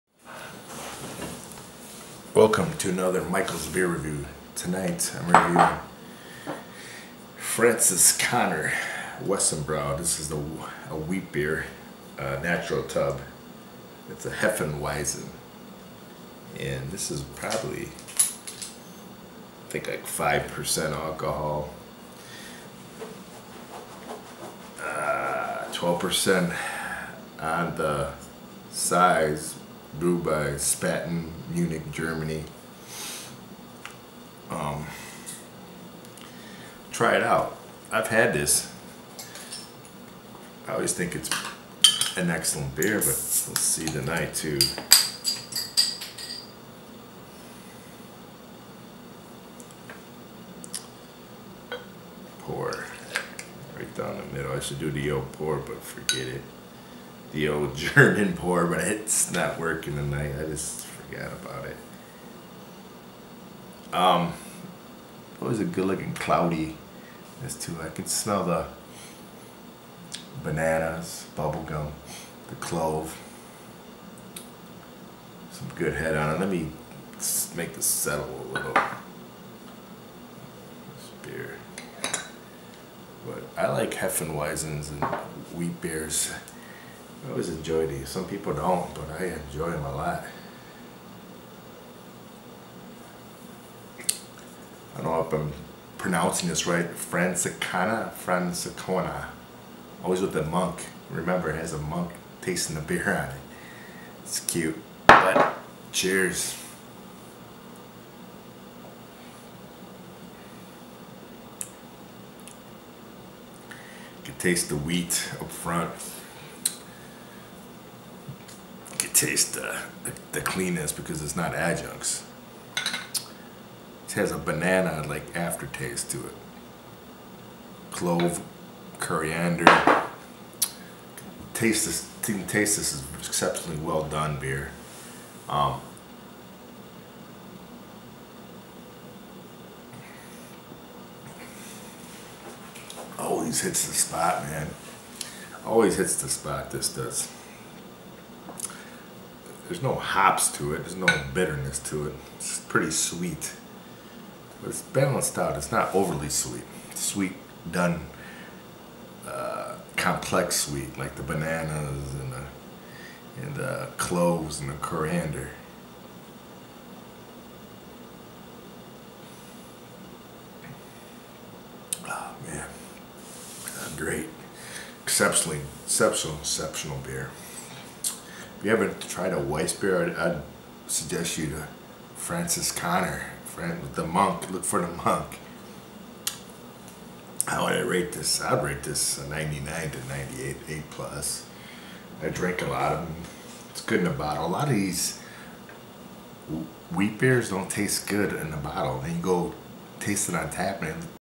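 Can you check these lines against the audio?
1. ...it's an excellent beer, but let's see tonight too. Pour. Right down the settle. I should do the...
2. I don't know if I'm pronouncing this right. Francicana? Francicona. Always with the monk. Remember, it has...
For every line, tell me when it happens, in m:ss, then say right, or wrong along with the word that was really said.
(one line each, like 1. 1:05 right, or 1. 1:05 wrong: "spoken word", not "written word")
1. 0:41 wrong: "middle", not "settle"
2. 1:34 right.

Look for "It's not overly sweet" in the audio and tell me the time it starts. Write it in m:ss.
2:35.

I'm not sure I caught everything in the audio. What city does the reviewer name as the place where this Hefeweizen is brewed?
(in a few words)
Munich.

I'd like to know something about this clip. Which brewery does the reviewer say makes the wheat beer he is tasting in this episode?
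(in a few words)
Spaten.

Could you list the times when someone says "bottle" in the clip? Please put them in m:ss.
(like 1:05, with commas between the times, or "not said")
3:14, 3:18.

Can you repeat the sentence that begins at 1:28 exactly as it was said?
Some people don't, but I enjoy them a lot.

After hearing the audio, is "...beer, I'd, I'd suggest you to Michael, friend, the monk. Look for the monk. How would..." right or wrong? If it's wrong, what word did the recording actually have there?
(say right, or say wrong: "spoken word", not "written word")
wrong: "Franziskaner", not "Michael".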